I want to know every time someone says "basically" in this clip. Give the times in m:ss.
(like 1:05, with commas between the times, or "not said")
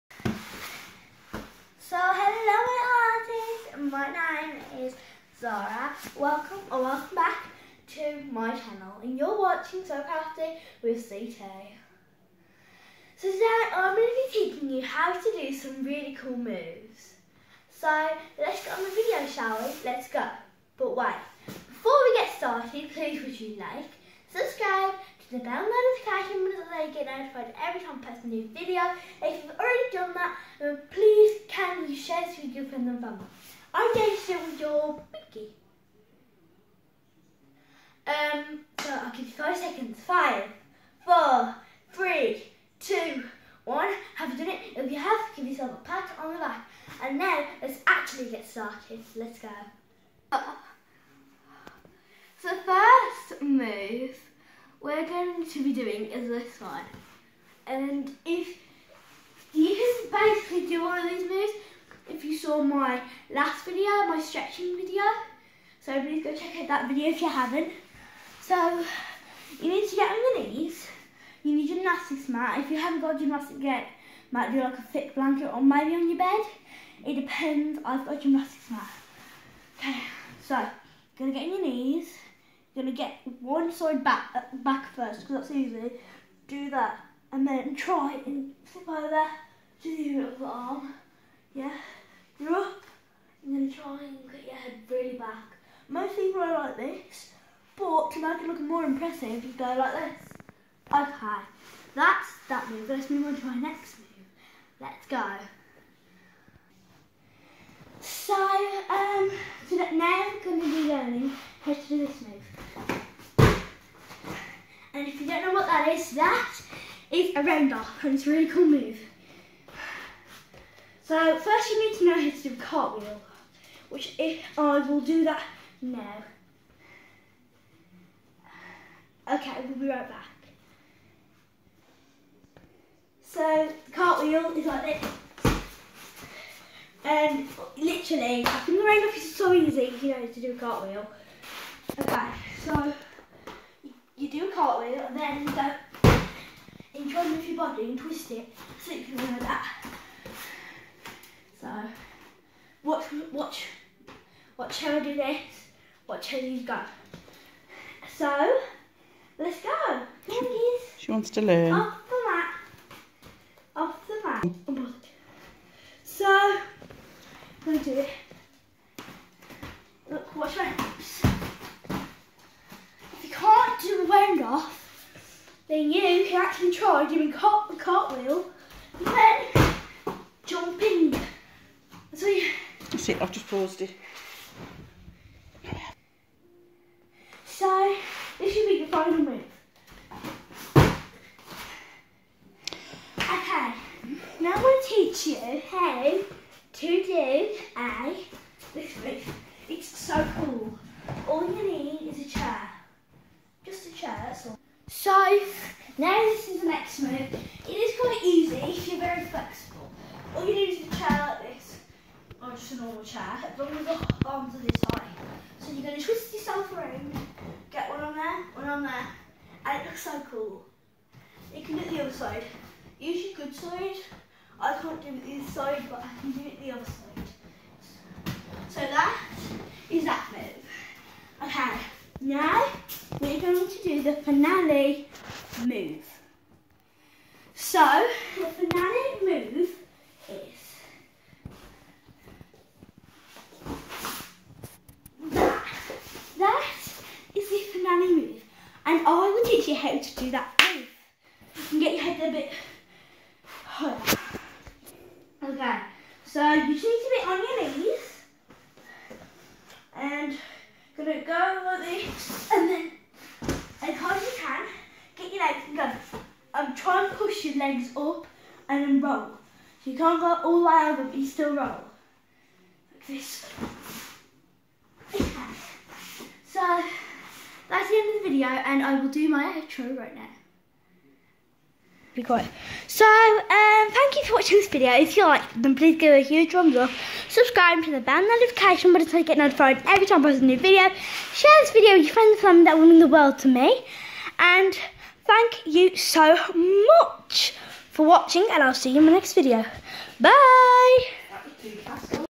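1:00.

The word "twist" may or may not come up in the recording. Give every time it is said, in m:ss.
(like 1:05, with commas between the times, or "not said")
2:27, 3:36.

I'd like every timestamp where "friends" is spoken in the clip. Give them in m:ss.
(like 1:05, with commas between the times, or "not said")
0:32, 4:52.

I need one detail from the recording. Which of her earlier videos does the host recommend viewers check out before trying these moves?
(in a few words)
stretching video.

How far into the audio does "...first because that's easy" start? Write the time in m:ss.
1:24.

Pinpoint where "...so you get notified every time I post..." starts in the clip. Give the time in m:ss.
4:49.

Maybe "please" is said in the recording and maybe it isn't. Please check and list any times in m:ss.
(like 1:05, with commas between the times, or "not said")
0:22, 0:30, 1:06, 4:45.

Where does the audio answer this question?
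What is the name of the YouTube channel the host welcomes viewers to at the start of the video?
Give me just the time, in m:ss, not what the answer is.
0:09.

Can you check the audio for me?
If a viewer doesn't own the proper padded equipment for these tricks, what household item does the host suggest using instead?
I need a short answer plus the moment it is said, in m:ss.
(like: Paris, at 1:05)
thick blanket, at 1:14.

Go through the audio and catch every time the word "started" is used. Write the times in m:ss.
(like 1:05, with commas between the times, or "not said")
0:22, 0:48.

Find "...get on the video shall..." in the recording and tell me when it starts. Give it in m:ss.
0:18.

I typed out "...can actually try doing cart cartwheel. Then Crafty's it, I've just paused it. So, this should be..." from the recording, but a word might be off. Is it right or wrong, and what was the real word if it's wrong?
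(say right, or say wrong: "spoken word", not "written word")
wrong: "That", not "Crafty".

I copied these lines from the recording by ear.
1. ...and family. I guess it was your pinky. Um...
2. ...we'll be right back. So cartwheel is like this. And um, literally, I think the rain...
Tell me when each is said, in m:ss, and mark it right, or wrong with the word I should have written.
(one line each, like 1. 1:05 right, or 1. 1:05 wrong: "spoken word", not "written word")
1. 0:32 right
2. 2:09 right.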